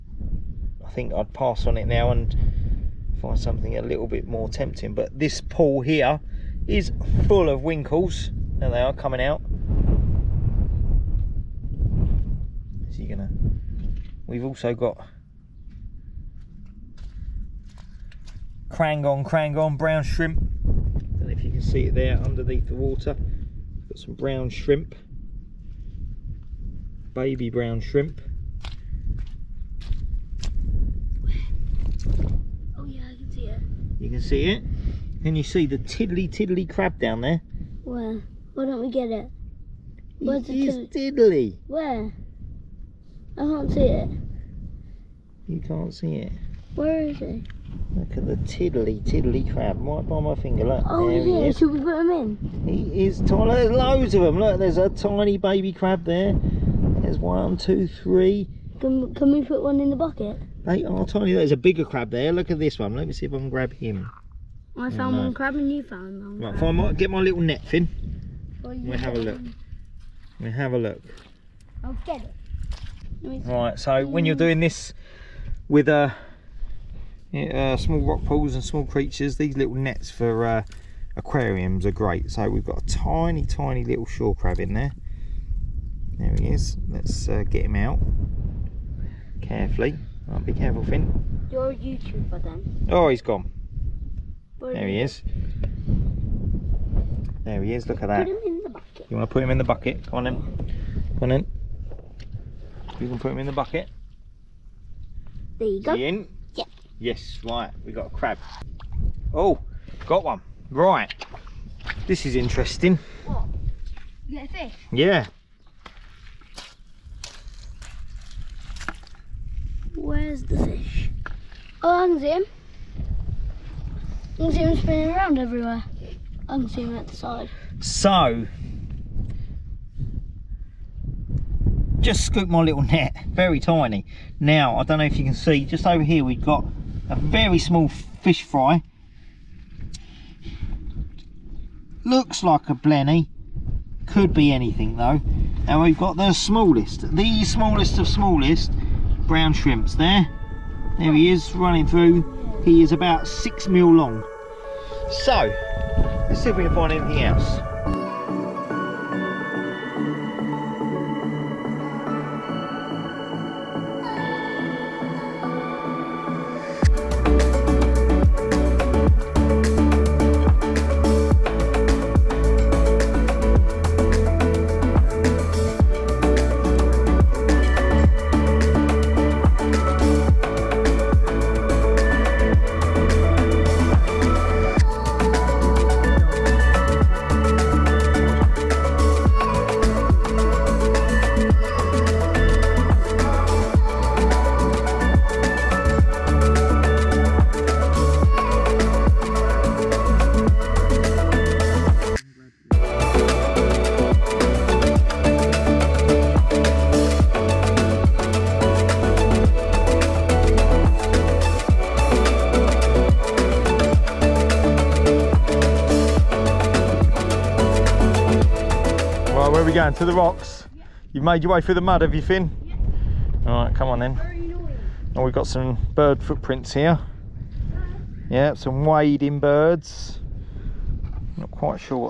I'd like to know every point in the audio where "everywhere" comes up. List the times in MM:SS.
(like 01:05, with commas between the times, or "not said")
02:05.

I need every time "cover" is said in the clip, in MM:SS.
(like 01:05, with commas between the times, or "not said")
not said.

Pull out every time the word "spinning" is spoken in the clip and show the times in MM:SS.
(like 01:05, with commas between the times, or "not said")
02:04.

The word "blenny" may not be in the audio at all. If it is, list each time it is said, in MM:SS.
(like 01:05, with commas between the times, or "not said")
02:22.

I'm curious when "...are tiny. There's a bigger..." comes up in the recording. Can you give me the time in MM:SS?
01:00.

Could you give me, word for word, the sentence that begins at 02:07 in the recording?
So, just scooped my little net, very tiny.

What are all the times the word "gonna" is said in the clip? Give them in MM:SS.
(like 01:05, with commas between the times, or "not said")
00:13.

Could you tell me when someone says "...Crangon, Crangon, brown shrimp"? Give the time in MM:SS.
00:18.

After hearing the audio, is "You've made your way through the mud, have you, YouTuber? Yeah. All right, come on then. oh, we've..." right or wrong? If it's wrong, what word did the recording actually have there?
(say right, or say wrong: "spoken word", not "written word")
wrong: "Finn", not "YouTuber".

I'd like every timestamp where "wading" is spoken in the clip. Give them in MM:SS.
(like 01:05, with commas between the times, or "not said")
03:48.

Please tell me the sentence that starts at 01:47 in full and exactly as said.
Yes, right, we got a crab.